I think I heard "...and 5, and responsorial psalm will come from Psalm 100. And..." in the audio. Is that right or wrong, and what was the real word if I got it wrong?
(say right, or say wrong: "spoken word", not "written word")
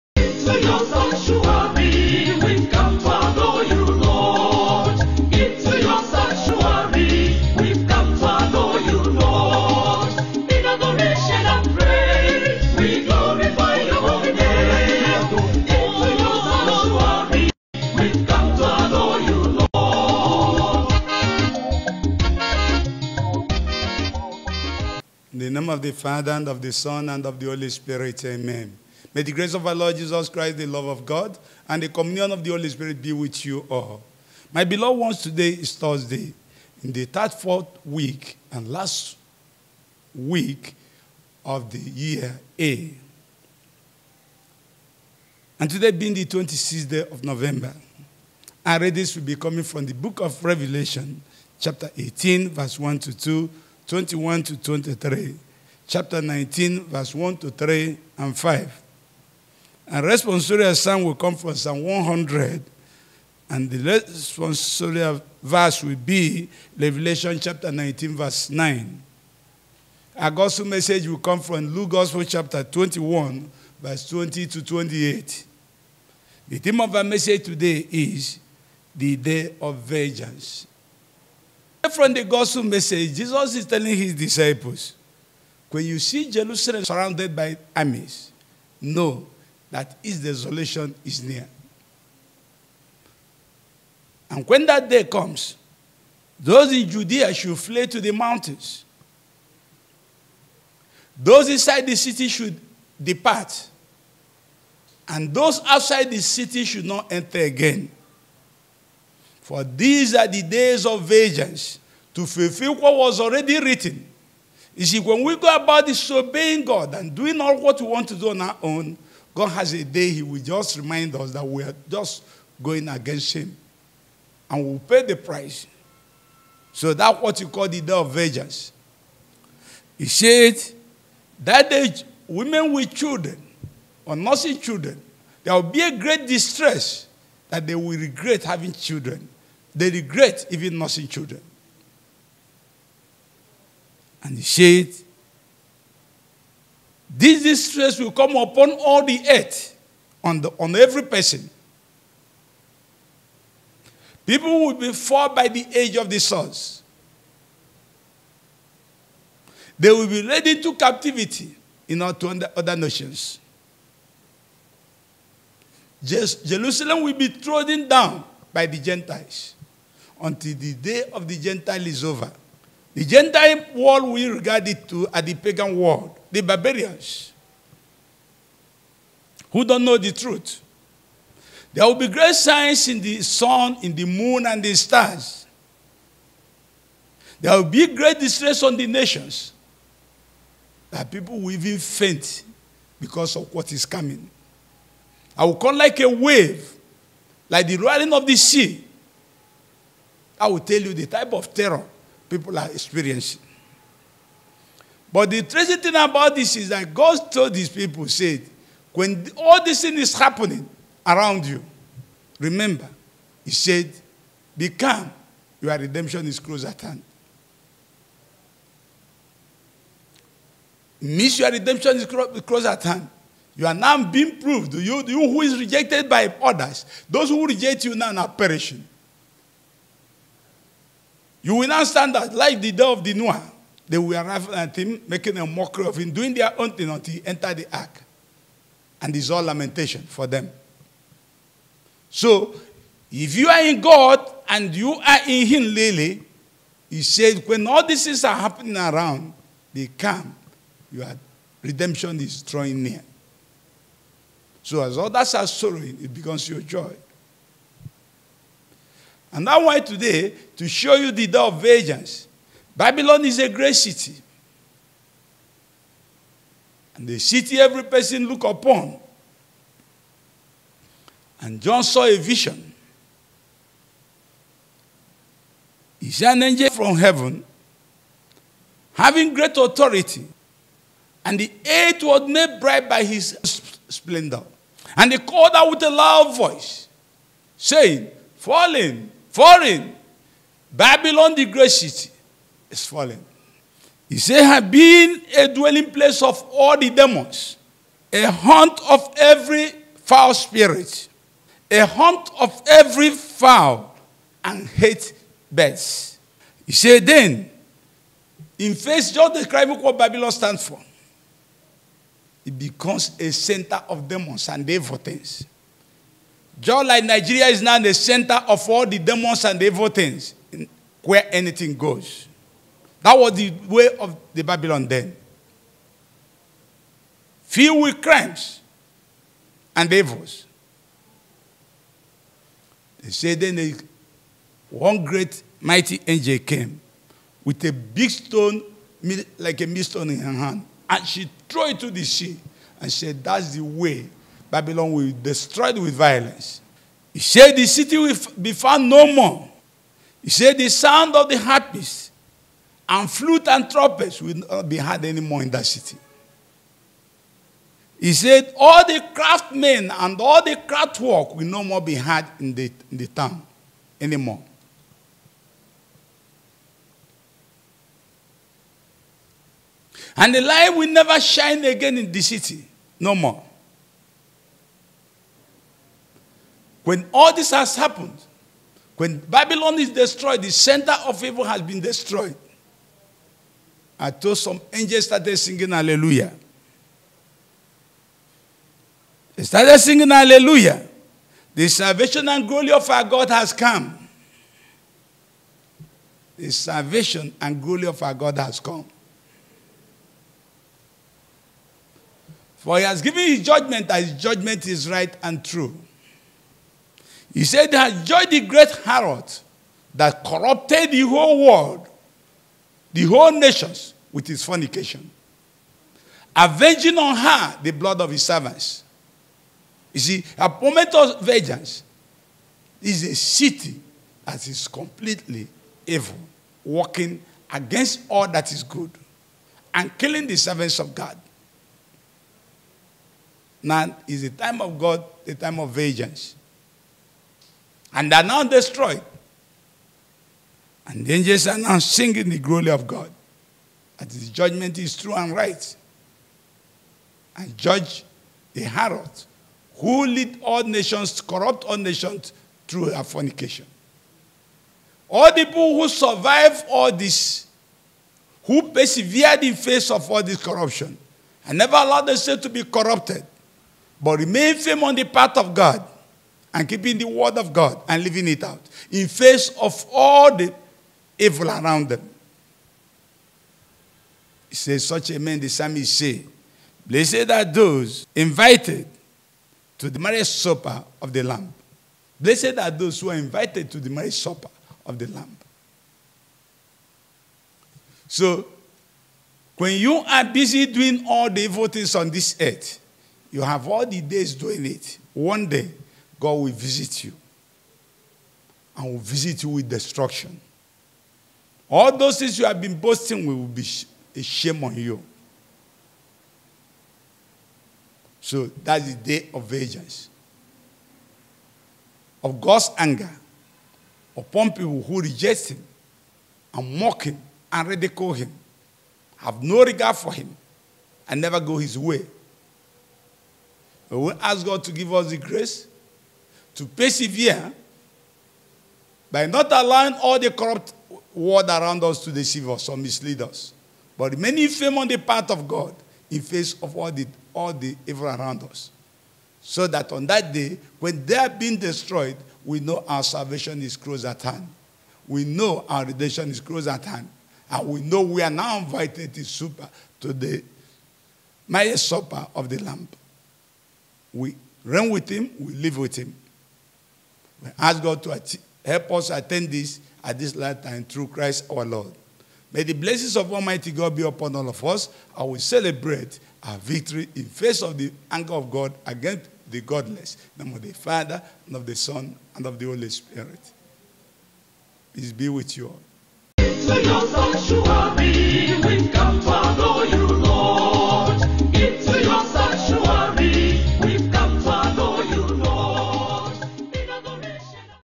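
right.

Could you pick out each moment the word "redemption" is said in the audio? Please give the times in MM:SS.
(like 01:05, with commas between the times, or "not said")
03:35, 03:41, 04:11, 09:05.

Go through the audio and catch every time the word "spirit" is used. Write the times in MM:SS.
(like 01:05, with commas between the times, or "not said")
00:32, 05:00, 09:32.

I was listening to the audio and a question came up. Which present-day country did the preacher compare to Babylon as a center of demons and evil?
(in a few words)
Nigeria.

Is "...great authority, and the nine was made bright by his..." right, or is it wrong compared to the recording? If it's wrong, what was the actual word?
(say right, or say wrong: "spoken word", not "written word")
wrong: "eight", not "nine".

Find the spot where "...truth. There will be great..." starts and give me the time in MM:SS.
03:00.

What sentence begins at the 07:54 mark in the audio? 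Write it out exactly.
He says, such a man, the psalmist say, blessed are those invited to the marriage supper of the Lamb.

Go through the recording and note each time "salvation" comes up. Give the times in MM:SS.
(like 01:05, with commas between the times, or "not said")
06:31, 06:36, 09:03.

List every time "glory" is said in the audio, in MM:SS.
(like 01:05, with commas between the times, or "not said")
06:32, 06:37, 07:22.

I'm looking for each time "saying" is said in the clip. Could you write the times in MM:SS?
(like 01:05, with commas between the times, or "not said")
04:47.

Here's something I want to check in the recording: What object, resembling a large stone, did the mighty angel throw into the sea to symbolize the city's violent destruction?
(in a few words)
A millstone.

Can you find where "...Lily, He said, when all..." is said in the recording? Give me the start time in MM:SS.
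04:05.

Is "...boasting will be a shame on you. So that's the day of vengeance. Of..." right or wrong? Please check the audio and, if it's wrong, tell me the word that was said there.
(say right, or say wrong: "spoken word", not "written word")
right.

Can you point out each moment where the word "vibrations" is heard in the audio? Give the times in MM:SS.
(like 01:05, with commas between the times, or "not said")
not said.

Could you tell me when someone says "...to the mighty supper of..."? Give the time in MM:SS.
09:10.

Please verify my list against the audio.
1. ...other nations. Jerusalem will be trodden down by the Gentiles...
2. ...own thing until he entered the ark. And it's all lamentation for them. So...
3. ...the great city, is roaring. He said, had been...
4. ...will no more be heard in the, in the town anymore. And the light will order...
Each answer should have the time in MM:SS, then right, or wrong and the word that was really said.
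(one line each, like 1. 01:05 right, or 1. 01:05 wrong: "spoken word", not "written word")
1. 02:42 right
2. 03:56 right
3. 04:51 wrong: "falling", not "roaring"
4. 06:01 wrong: "never", not "order".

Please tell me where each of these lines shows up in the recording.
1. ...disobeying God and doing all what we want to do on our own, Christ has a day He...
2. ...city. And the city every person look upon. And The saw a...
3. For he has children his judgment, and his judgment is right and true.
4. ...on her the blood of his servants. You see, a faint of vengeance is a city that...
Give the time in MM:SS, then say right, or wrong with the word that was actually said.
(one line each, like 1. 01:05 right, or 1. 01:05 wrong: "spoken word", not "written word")
1. 01:55 wrong: "God", not "Christ"
2. 04:23 wrong: "John", not "The"
3. 06:42 wrong: "given", not "children"
4. 06:56 wrong: "moment", not "faint".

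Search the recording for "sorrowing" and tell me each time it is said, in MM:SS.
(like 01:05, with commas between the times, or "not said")
04:15.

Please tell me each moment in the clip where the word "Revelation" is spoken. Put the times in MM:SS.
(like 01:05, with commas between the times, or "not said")
00:50, 01:06.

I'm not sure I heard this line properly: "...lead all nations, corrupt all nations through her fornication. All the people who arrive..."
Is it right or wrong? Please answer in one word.
wrong.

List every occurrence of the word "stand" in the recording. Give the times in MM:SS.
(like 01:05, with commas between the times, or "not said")
03:51, 05:10.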